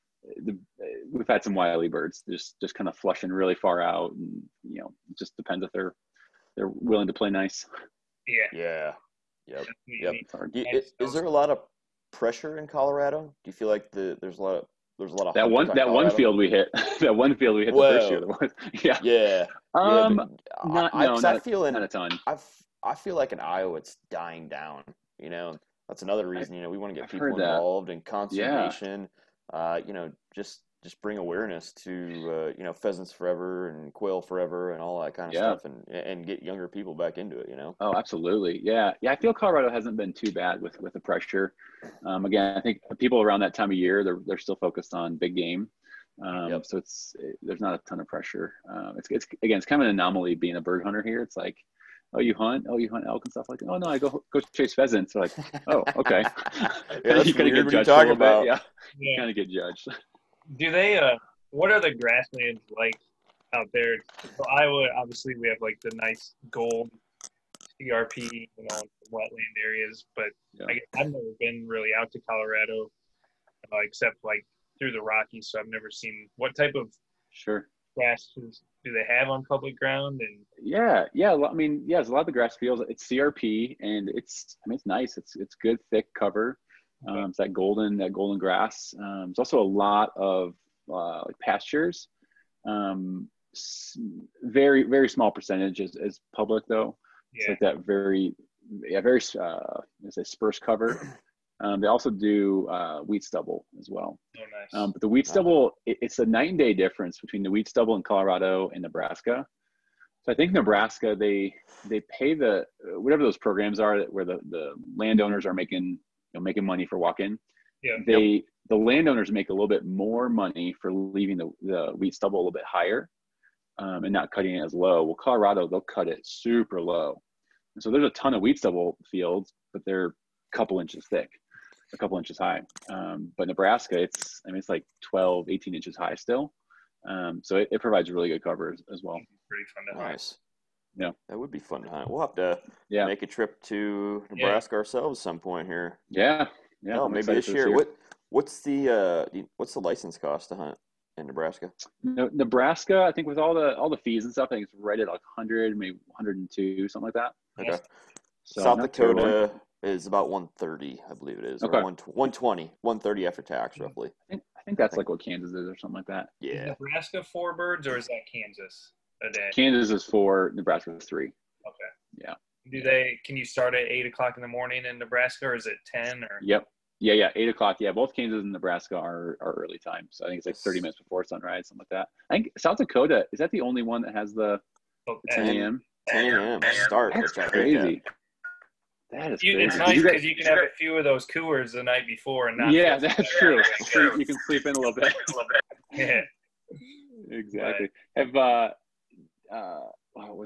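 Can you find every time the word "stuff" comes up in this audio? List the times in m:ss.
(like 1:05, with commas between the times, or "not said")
0:35, 0:53, 2:34.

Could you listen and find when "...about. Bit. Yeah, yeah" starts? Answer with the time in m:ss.
0:58.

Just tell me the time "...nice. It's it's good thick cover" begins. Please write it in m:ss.
1:24.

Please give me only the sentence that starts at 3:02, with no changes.
I think South Dakota, is that the only one that has the, oh, the 10 a.m.?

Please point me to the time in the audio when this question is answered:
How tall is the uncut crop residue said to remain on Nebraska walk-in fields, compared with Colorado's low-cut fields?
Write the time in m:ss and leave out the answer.
2:15.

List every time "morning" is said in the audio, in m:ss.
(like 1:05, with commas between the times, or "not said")
2:54.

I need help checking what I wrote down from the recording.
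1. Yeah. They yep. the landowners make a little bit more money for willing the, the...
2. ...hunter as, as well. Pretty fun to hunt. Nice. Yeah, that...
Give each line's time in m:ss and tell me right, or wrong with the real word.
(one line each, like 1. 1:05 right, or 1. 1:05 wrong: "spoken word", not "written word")
1. 1:57 wrong: "leaving", not "willing"
2. 2:18 wrong: "cover", not "hunter".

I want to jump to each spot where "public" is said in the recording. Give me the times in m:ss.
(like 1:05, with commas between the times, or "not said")
1:19, 1:36.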